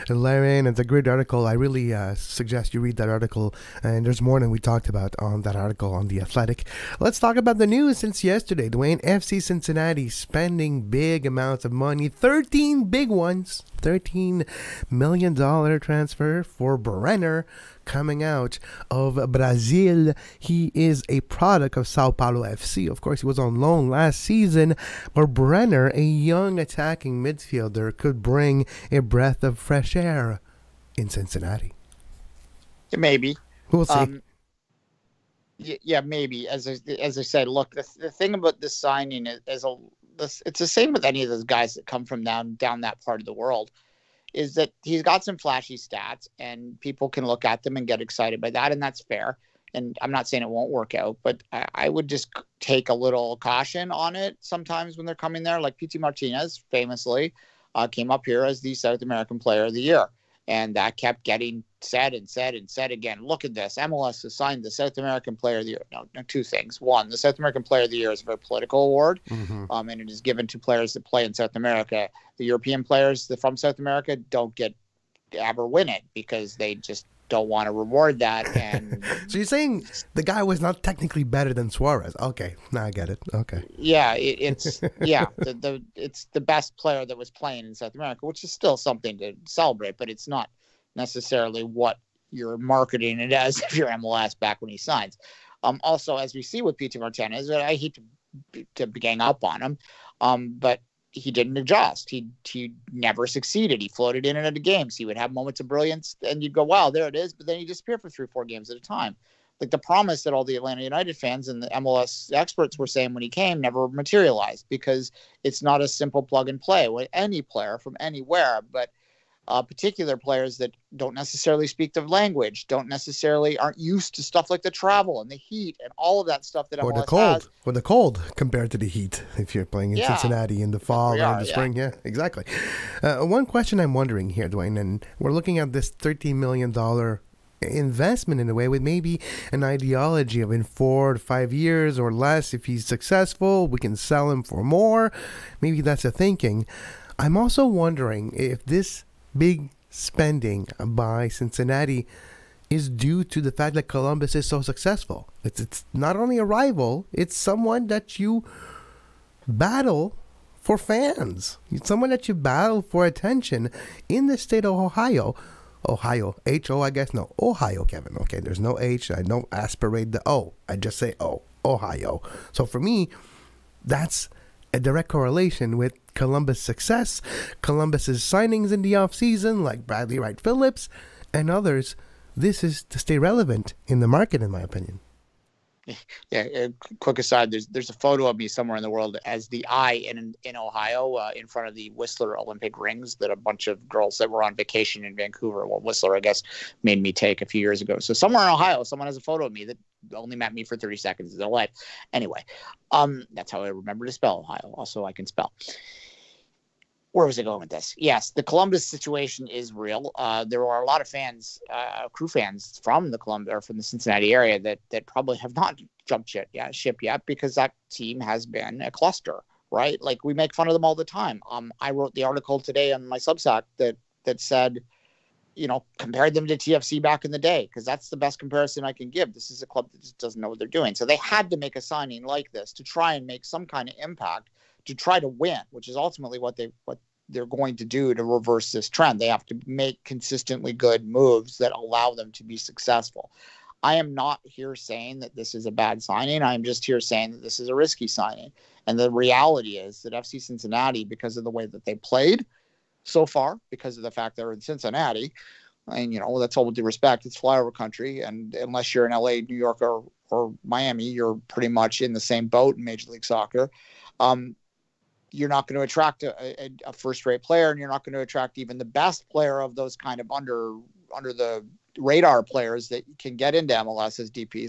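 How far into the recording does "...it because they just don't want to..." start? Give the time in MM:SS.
01:15.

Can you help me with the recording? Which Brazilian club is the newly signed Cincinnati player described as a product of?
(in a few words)
Sao Paulo FC.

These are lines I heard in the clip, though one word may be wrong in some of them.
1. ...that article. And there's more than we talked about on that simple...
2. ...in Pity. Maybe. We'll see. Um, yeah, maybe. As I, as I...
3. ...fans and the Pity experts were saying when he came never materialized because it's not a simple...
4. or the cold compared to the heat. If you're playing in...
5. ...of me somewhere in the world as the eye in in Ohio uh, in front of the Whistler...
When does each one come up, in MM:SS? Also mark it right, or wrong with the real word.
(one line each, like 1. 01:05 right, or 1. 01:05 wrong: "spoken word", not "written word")
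1. 00:02 wrong: "article", not "simple"
2. 00:30 wrong: "Cincinnati", not "Pity"
3. 01:51 wrong: "MLS", not "Pity"
4. 02:07 right
5. 03:08 right.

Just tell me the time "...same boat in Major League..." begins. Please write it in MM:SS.
04:22.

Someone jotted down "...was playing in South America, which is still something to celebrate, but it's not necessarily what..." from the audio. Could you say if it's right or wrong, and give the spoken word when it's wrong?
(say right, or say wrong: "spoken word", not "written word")
right.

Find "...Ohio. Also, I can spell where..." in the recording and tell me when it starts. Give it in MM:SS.
03:24.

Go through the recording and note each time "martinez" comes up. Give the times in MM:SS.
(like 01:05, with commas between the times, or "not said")
00:55, 01:36.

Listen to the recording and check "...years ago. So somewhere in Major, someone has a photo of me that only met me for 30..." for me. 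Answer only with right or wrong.
wrong.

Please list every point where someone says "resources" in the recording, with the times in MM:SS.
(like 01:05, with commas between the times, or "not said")
not said.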